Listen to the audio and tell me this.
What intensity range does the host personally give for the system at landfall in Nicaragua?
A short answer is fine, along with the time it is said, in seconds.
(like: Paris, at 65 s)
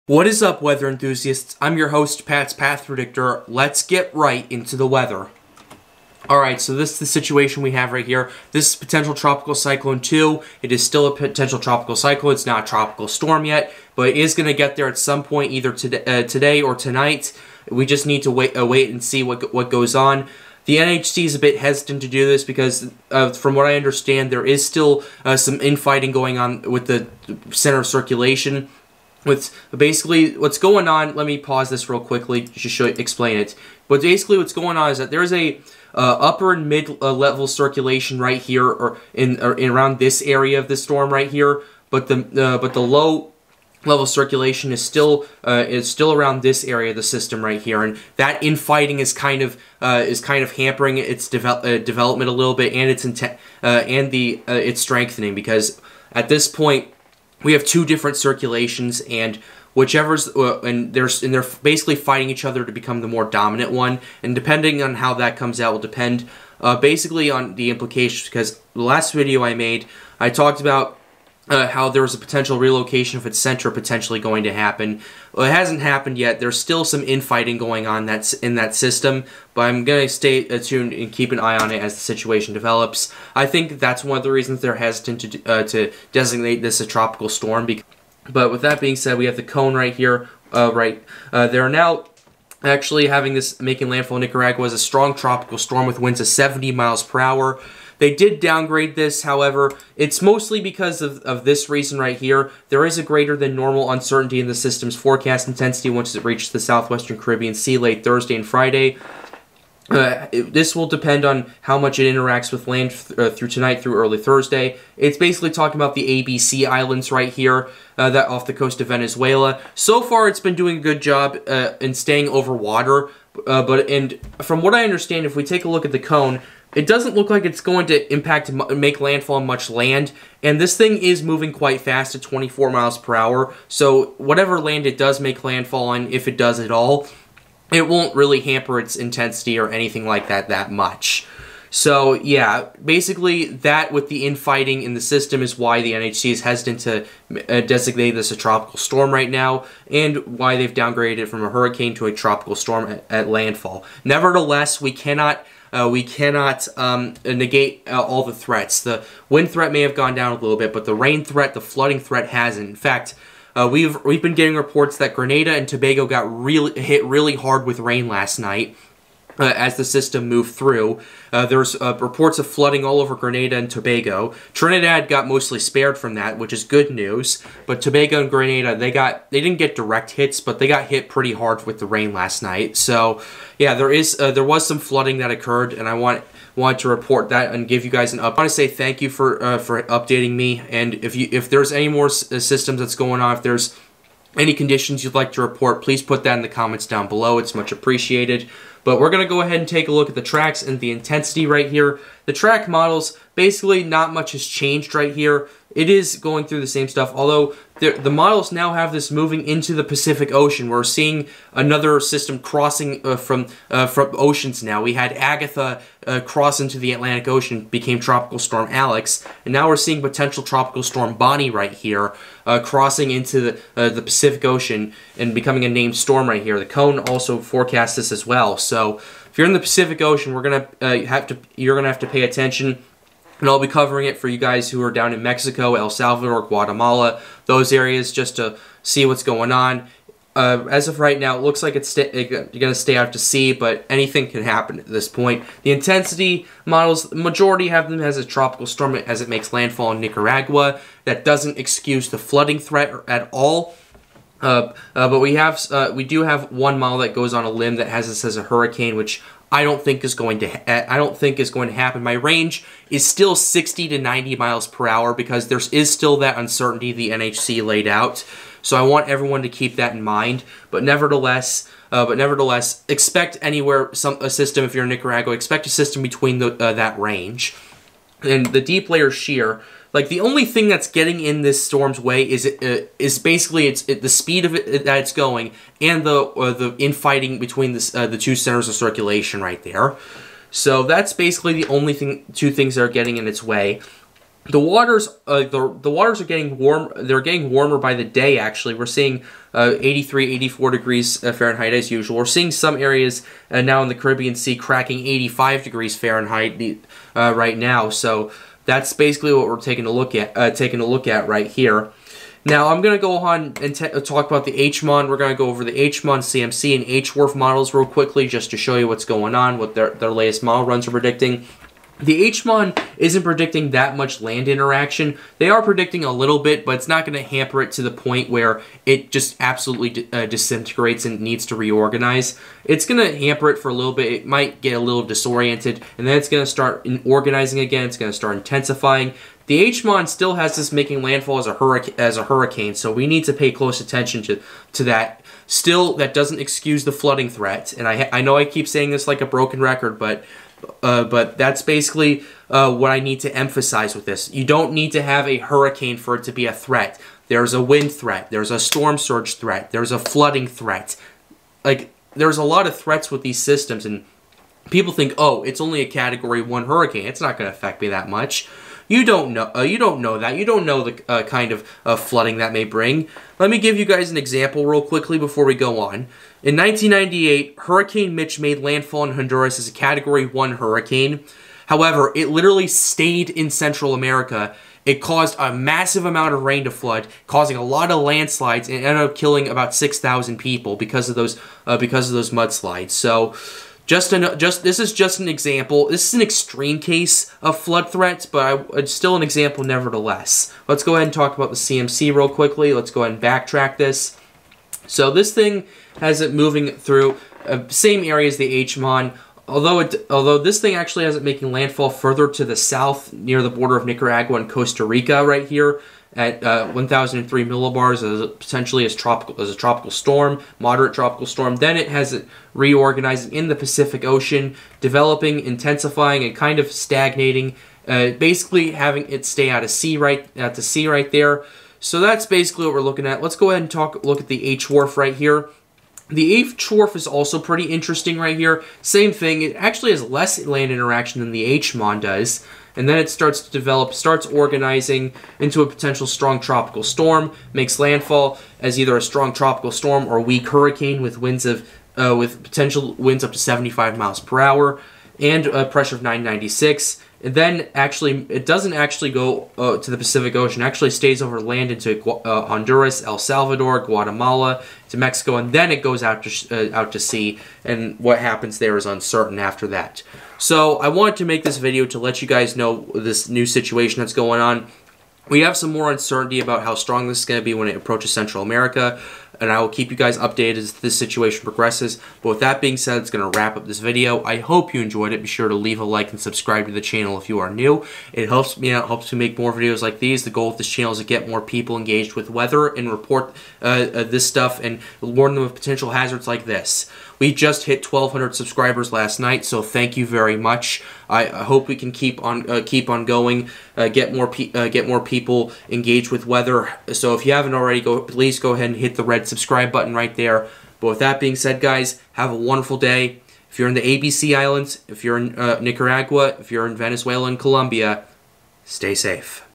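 60 to 90 mph, at 263 s.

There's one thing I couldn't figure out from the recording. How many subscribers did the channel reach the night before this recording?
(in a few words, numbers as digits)
1,200.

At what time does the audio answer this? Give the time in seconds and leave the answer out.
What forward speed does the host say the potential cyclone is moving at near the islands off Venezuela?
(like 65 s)
132 s.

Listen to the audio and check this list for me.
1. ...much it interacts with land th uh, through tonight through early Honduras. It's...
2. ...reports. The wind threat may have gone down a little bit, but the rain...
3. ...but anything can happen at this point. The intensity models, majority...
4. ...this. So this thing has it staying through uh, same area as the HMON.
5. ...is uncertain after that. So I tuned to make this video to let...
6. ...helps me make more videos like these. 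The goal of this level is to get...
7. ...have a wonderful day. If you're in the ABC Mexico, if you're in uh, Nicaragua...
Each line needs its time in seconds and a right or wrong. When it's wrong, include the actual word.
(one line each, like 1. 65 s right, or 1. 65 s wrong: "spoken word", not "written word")
1. 111 s wrong: "Thursday", not "Honduras"
2. 158 s wrong: "threats", not "reports"
3. 243 s right
4. 403 s wrong: "moving", not "staying"
5. 468 s wrong: "wanted", not "tuned"
6. 488 s wrong: "channel", not "level"
7. 512 s wrong: "Islands", not "Mexico".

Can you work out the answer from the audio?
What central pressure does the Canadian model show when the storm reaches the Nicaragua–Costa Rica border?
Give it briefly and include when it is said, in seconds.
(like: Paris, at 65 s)
1,003 millibars, at 416 s.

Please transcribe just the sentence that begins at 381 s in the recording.
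However, it literally stayed in Central America.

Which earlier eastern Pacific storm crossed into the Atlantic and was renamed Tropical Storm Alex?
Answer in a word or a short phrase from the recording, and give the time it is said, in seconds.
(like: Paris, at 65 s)
Agatha, at 215 s.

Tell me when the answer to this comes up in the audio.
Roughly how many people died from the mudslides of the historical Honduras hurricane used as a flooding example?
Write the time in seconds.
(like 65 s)
389 s.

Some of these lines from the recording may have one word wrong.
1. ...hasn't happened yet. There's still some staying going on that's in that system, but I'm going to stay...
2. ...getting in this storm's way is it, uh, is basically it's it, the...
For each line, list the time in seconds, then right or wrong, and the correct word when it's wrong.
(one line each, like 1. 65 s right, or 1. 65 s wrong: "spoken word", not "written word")
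1. 75 s wrong: "infighting", not "staying"
2. 280 s right.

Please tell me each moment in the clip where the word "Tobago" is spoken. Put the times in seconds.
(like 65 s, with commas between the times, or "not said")
165 s, 173 s, 177 s.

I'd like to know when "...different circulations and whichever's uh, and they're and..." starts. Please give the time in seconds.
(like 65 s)
57 s.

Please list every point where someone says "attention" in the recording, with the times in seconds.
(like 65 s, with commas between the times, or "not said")
232 s, 343 s.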